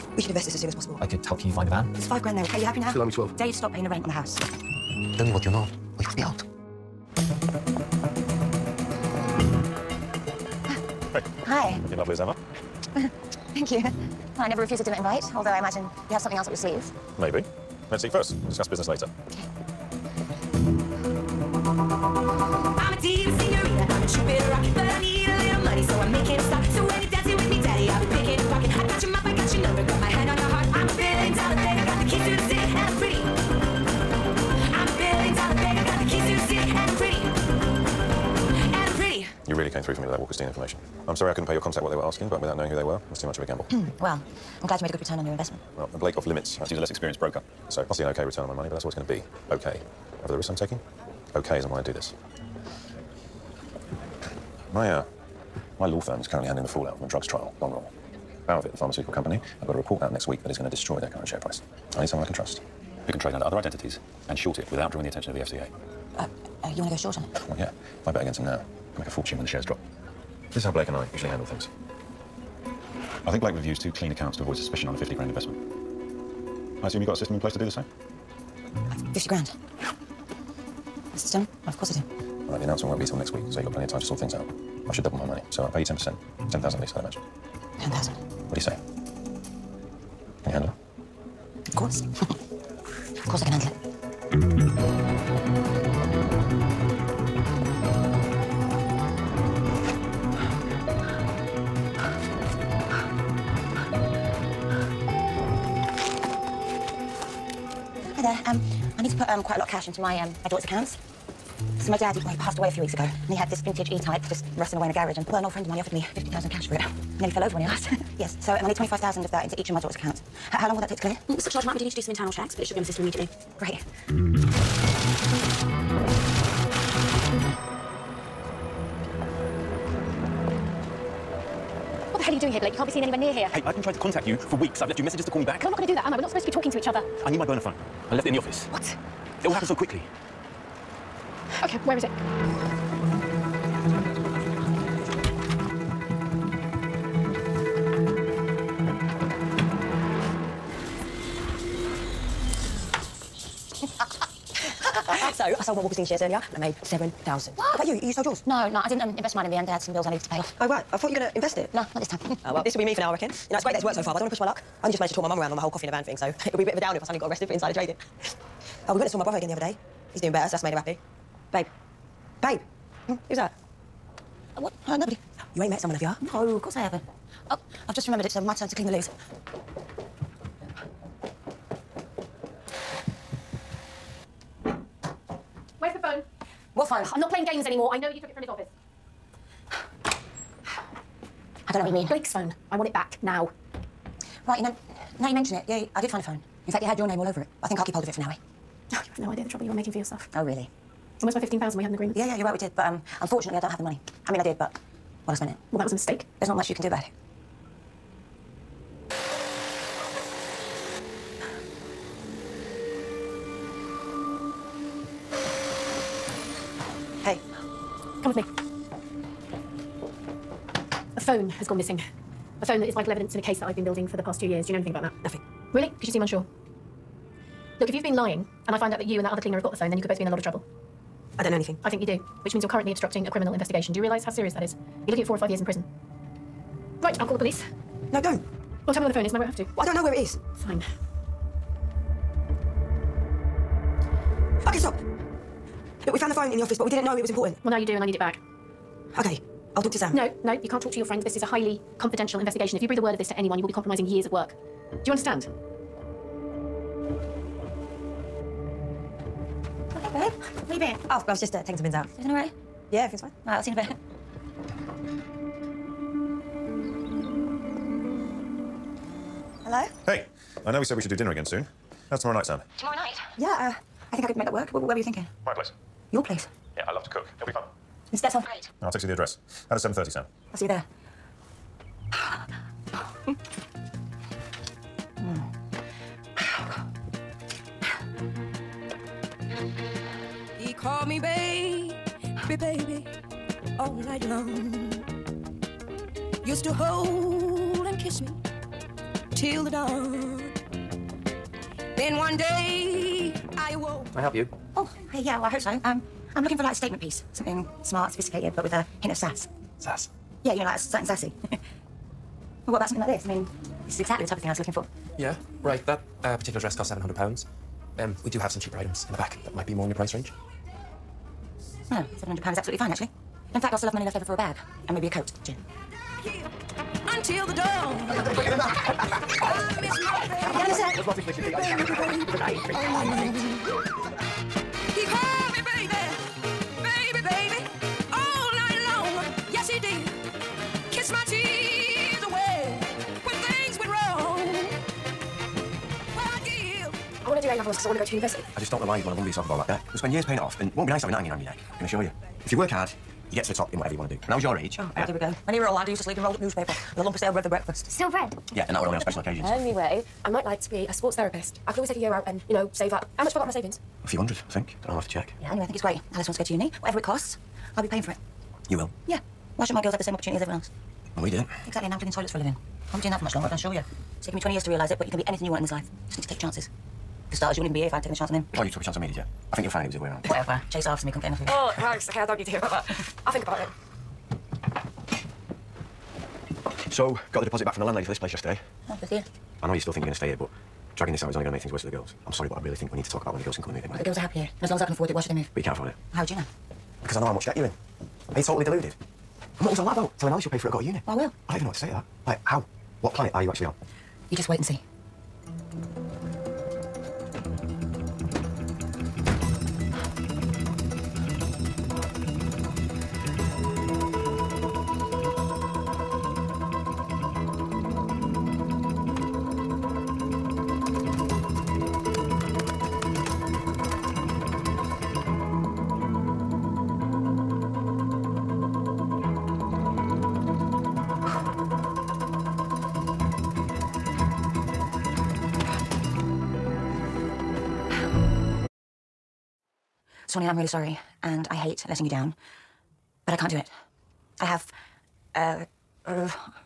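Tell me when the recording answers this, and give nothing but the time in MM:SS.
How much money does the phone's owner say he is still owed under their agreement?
03:21.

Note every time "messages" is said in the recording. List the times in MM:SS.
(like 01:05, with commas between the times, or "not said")
02:15.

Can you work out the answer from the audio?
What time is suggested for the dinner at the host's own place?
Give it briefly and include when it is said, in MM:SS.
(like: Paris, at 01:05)
7.30, at 04:39.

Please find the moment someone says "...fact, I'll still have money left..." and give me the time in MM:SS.
05:23.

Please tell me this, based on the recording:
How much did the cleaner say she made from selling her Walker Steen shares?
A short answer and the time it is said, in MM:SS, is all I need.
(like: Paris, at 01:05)
7,000, at 02:36.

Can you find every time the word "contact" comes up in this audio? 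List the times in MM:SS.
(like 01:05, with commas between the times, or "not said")
00:41, 02:13.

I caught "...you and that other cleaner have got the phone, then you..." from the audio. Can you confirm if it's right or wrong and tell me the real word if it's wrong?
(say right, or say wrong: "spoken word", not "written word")
right.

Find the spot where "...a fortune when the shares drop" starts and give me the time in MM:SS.
01:09.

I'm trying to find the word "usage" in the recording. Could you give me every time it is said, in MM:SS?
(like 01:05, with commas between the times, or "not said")
not said.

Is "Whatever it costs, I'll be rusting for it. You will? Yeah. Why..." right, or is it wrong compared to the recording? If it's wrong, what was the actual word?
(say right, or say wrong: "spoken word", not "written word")
wrong: "paying", not "rusting".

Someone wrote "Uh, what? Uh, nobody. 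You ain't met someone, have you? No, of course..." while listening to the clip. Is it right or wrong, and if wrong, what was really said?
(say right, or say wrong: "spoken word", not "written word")
right.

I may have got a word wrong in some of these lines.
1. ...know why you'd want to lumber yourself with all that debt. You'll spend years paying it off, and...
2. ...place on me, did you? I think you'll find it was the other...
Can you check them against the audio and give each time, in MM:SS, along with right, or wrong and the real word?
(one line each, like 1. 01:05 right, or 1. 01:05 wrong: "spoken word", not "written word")
1. 05:48 right
2. 06:18 wrong: "chance", not "place".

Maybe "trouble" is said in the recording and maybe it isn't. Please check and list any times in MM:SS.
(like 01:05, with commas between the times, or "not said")
03:19, 03:50.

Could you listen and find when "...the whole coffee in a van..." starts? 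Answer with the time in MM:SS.
02:45.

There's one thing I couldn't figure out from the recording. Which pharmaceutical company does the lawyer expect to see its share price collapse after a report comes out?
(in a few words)
Bowervit.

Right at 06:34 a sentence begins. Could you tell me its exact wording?
As long as I can afford it, why should they move?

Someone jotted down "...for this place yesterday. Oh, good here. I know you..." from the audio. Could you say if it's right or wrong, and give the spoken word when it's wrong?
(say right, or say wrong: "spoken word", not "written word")
right.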